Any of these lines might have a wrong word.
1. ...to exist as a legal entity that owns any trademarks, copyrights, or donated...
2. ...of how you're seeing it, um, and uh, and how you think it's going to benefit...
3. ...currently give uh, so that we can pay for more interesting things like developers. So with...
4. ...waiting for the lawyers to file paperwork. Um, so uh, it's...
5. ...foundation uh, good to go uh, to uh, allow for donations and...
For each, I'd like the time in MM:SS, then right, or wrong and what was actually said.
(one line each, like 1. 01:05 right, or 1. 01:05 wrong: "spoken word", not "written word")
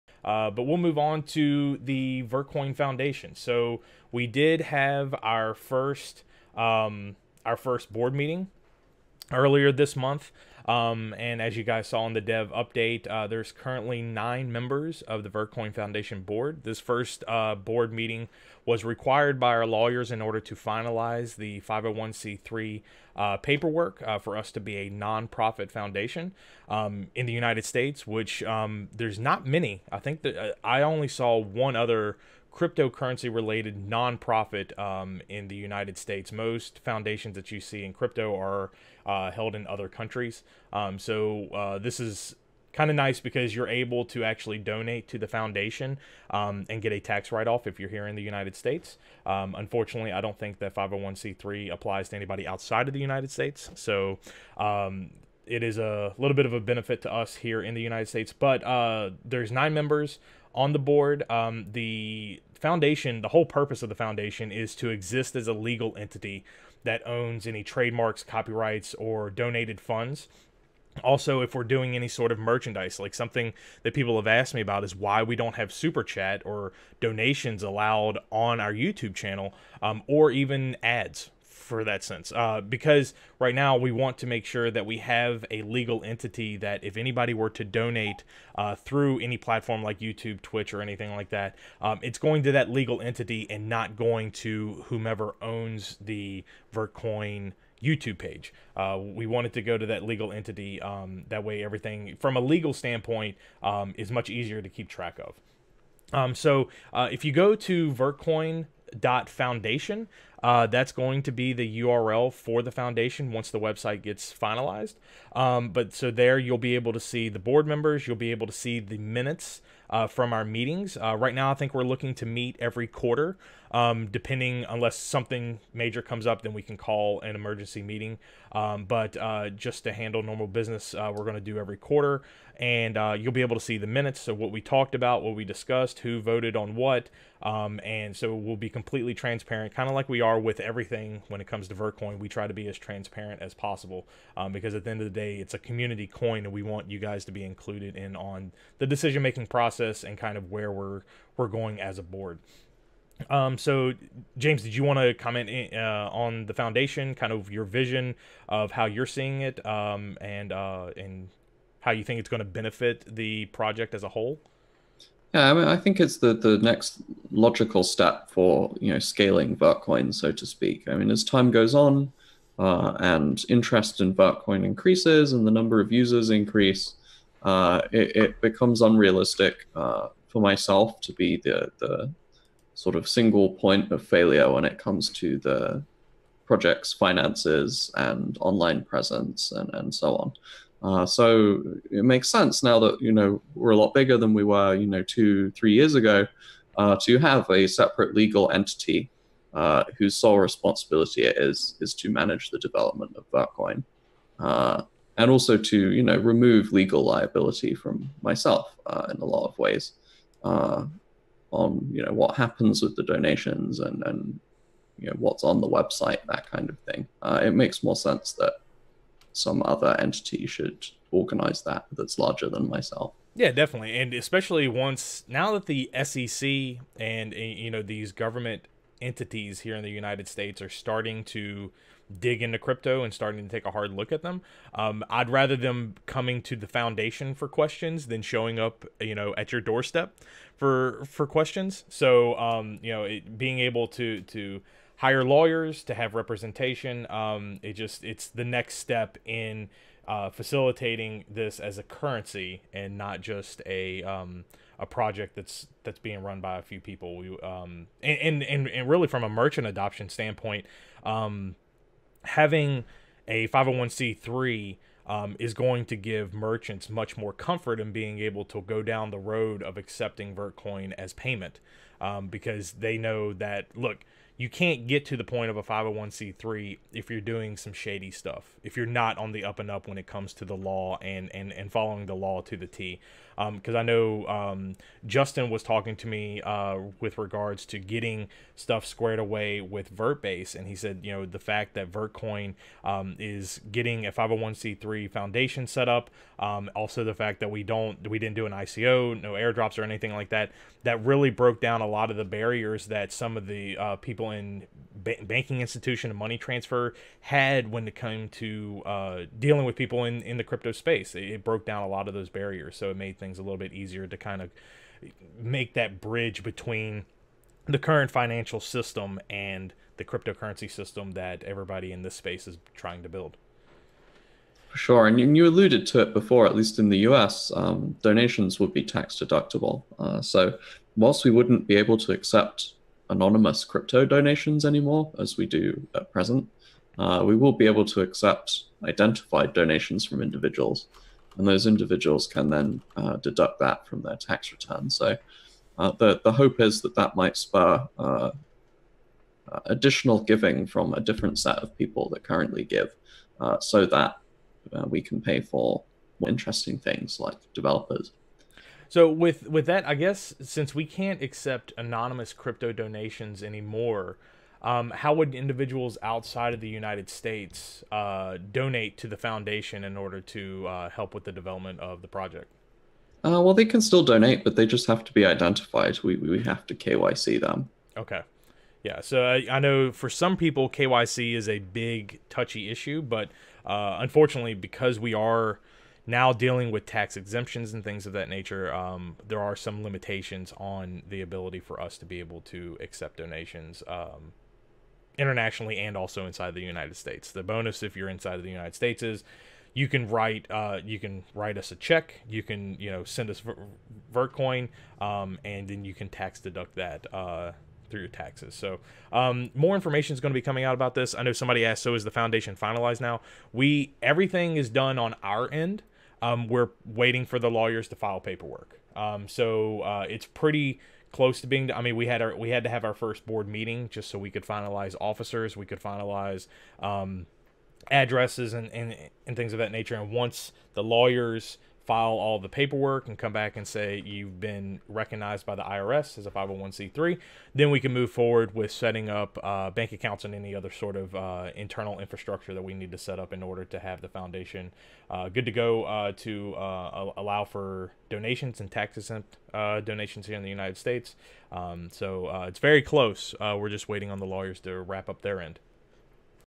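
1. 01:04 right
2. 02:38 right
3. 05:52 right
4. 06:56 right
5. 07:24 right.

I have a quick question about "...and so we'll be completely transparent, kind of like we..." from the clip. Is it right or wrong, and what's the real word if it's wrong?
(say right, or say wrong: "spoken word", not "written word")
right.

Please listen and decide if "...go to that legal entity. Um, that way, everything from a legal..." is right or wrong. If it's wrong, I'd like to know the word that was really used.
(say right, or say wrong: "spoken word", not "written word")
right.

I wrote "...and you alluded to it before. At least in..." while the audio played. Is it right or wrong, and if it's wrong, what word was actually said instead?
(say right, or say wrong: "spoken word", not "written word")
right.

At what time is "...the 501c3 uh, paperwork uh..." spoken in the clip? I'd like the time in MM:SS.
00:21.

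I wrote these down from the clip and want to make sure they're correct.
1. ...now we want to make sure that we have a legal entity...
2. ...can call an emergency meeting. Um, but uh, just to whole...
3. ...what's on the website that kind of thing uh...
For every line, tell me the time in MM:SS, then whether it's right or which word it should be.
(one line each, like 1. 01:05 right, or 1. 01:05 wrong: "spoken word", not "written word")
1. 01:23 right
2. 02:06 wrong: "handle", not "whole"
3. 03:35 right.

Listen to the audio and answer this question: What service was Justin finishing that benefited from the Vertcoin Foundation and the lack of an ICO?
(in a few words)
Vertbase.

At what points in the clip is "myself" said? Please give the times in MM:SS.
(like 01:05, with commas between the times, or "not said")
03:00, 03:28, 03:42.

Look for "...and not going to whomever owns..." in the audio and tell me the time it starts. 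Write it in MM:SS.
01:33.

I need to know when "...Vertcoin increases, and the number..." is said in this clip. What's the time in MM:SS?
02:54.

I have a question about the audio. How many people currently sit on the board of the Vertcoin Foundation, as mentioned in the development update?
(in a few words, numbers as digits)
9.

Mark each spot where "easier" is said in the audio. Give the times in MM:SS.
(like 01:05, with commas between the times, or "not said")
01:44, 05:13.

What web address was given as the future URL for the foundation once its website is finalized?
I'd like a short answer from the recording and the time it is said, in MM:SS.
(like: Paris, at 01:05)
vertcoin.foundation, at 01:47.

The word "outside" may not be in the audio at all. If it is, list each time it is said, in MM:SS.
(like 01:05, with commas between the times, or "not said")
00:52, 06:06.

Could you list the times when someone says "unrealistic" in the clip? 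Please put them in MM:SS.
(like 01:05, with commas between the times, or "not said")
02:58.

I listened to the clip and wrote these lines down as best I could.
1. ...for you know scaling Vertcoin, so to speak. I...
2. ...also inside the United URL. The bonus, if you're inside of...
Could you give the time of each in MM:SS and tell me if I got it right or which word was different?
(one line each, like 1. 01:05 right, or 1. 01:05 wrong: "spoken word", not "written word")
1. 02:48 right
2. 06:35 wrong: "States", not "URL".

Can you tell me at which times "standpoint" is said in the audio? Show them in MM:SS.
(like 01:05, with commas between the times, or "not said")
01:42, 04:20.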